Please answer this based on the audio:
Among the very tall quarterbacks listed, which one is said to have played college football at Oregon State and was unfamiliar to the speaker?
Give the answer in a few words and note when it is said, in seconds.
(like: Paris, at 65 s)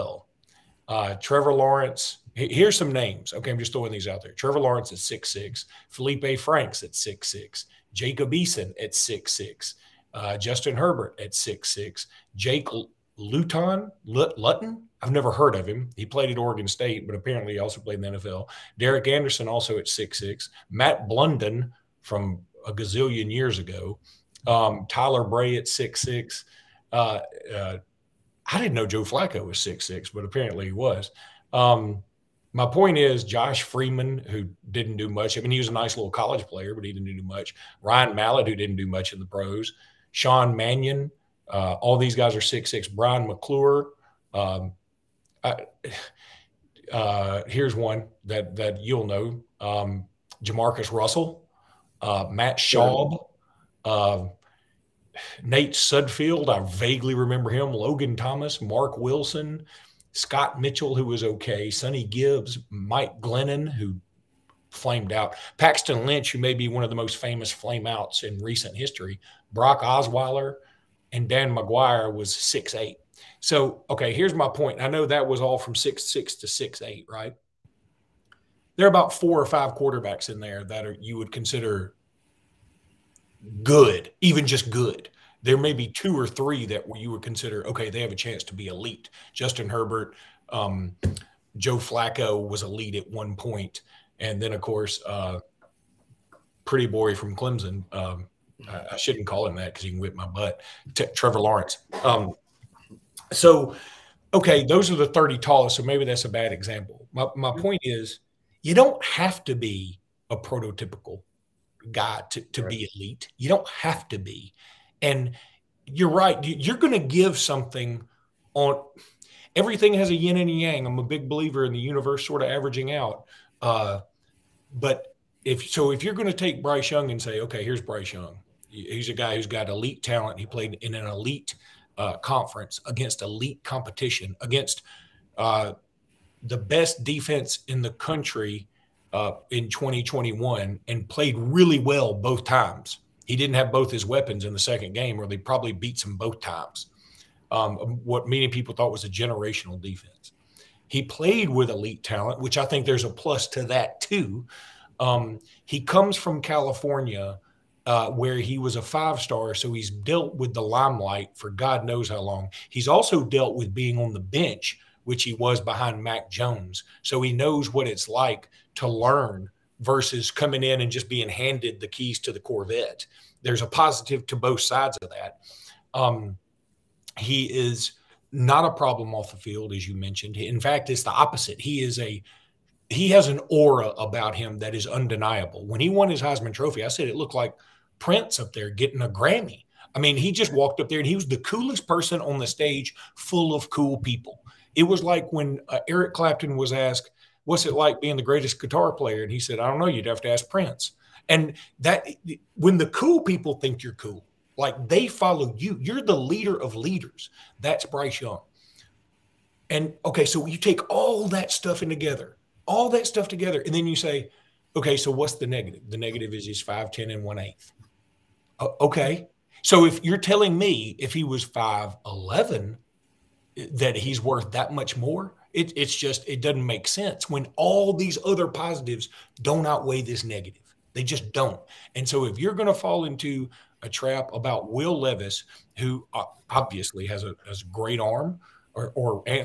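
Jake Luton, at 12 s.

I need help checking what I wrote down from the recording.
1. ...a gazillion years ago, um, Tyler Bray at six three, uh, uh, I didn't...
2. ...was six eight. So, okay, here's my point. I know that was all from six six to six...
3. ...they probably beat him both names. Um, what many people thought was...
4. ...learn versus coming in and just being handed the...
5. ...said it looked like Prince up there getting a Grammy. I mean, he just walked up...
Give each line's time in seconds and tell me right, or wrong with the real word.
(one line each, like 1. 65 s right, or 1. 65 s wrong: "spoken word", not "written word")
1. 22 s wrong: "six", not "three"
2. 72 s right
3. 145 s wrong: "times", not "names"
4. 168 s right
5. 186 s right.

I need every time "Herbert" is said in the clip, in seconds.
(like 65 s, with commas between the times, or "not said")
10 s, 89 s.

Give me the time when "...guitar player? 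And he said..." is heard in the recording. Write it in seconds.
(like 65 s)
198 s.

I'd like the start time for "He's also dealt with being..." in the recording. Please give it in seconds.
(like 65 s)
162 s.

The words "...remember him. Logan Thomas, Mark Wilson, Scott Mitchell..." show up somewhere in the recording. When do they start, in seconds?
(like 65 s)
57 s.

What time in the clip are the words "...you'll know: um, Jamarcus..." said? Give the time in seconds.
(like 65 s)
48 s.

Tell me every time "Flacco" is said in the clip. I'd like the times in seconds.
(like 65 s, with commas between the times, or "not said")
29 s, 91 s.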